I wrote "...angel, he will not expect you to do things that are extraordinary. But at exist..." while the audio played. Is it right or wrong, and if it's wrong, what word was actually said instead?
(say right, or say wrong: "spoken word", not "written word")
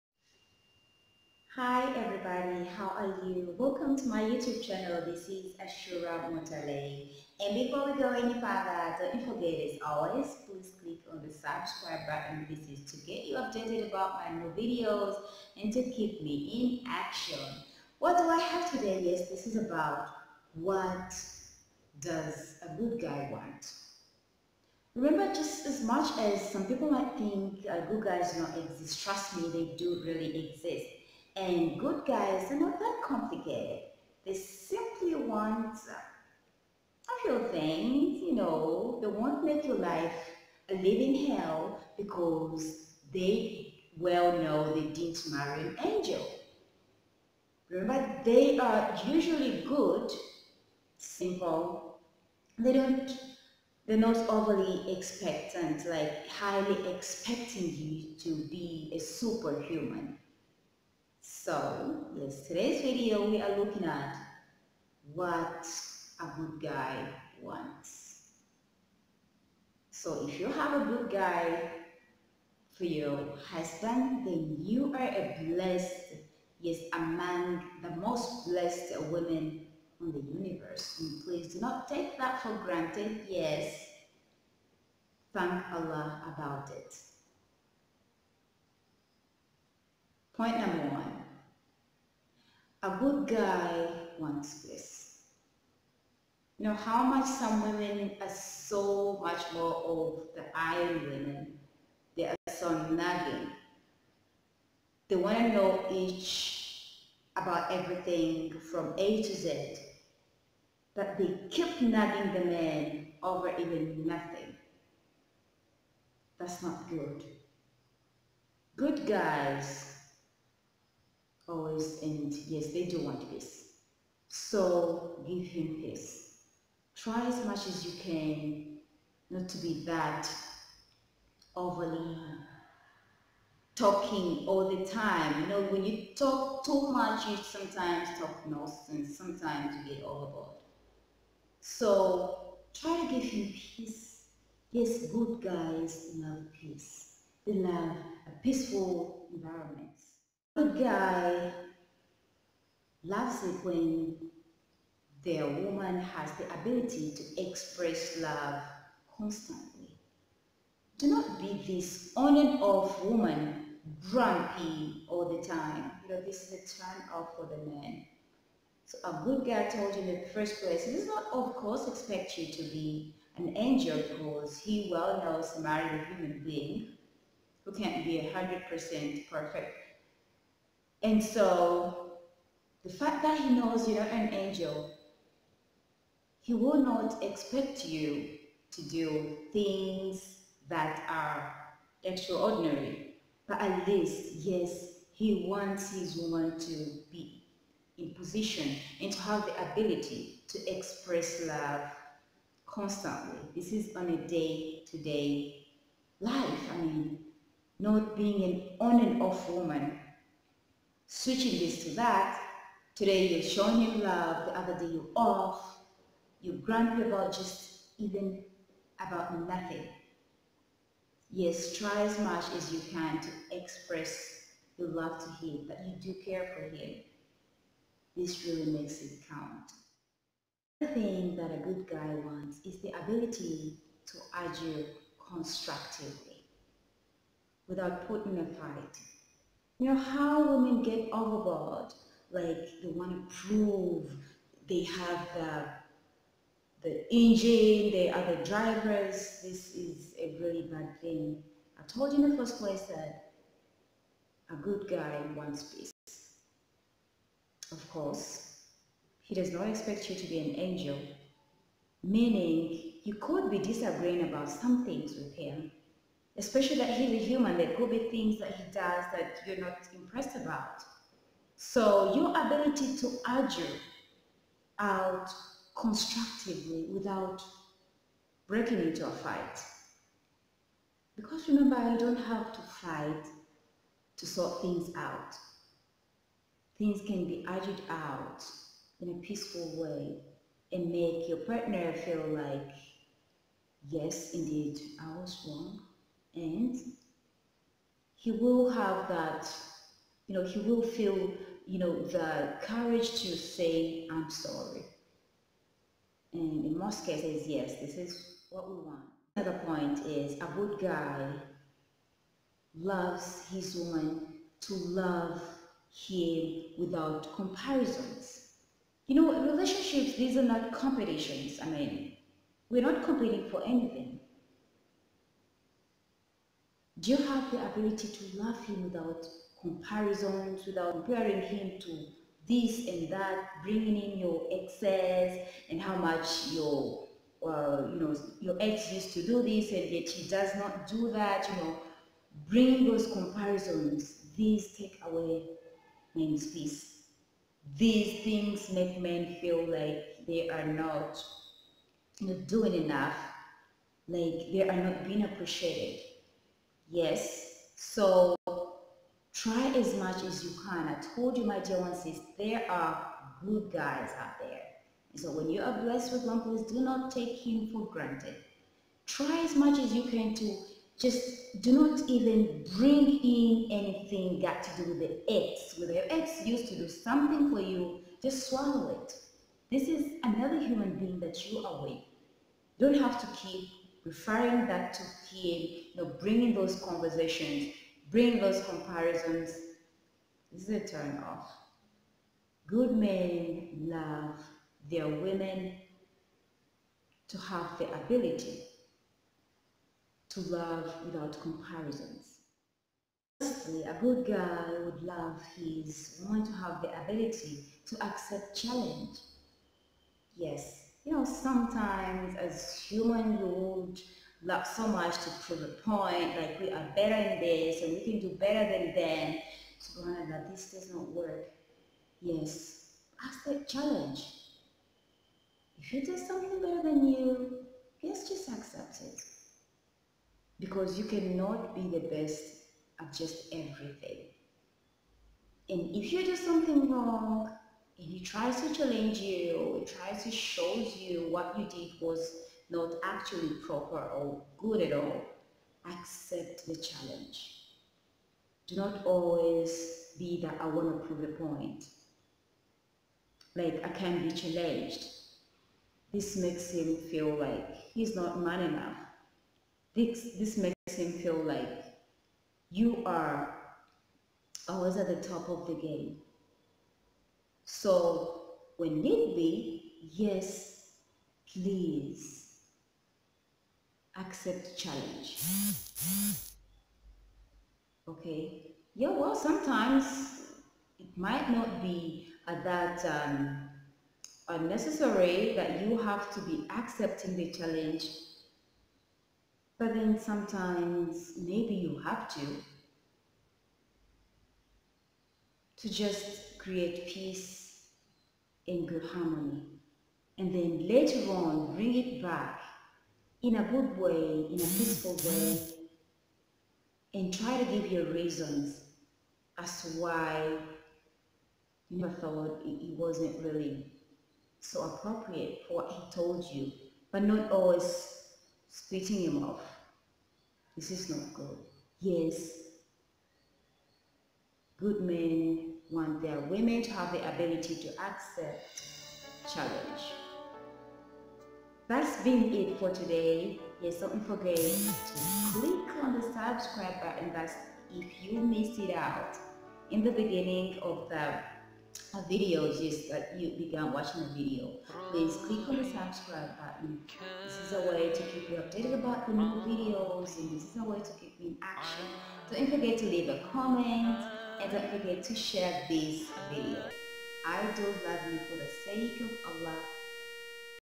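wrong: "least", not "exist".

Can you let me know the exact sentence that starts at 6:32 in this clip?
Good men love their women to have the ability to love without comparisons.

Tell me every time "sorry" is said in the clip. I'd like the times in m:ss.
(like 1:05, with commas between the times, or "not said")
5:04.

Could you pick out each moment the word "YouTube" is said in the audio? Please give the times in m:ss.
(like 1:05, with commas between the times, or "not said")
0:04.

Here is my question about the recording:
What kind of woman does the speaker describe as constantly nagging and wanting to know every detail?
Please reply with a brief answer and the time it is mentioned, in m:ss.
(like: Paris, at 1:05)
iron women, at 1:40.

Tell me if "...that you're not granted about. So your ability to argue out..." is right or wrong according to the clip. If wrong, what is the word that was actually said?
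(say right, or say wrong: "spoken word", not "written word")
wrong: "impressed", not "granted".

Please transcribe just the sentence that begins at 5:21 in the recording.
I mean, we're not competing for anything.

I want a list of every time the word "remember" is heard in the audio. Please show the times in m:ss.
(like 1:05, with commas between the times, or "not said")
0:24, 0:47, 4:41.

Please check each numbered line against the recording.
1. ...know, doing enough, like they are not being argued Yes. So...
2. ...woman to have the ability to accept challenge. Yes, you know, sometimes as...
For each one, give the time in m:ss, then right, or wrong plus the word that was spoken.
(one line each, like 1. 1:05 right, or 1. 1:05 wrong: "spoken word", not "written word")
1. 5:52 wrong: "appreciated", not "argued"
2. 6:46 right.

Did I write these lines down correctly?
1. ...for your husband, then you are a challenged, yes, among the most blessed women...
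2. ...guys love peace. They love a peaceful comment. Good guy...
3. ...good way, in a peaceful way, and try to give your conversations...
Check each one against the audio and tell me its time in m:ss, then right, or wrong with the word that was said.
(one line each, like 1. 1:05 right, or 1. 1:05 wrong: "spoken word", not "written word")
1. 1:12 wrong: "blessed", not "challenged"
2. 2:25 wrong: "environment", not "comment"
3. 8:23 wrong: "reasons", not "conversations".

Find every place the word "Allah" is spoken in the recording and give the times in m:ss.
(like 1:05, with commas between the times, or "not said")
1:25, 9:19.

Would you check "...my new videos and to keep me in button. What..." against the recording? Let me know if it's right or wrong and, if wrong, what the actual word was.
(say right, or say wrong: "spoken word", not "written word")
wrong: "action", not "button".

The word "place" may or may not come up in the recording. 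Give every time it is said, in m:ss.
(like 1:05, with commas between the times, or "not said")
2:50, 4:12.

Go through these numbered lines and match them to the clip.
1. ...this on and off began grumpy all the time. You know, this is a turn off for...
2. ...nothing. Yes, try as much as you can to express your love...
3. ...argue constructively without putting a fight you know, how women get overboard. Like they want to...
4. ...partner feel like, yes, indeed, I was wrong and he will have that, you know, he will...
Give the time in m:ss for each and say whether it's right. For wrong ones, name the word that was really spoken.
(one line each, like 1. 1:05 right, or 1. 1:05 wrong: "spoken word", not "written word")
1. 2:41 wrong: "woman", not "began"
2. 3:39 right
3. 3:54 right
4. 4:51 right.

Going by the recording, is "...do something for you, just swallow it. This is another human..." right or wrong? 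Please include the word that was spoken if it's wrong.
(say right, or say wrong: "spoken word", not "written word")
right.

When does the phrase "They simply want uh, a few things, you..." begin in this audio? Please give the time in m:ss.
0:34.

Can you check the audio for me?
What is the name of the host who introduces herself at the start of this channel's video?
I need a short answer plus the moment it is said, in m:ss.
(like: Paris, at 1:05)
Ashuurah Mutale, at 0:05.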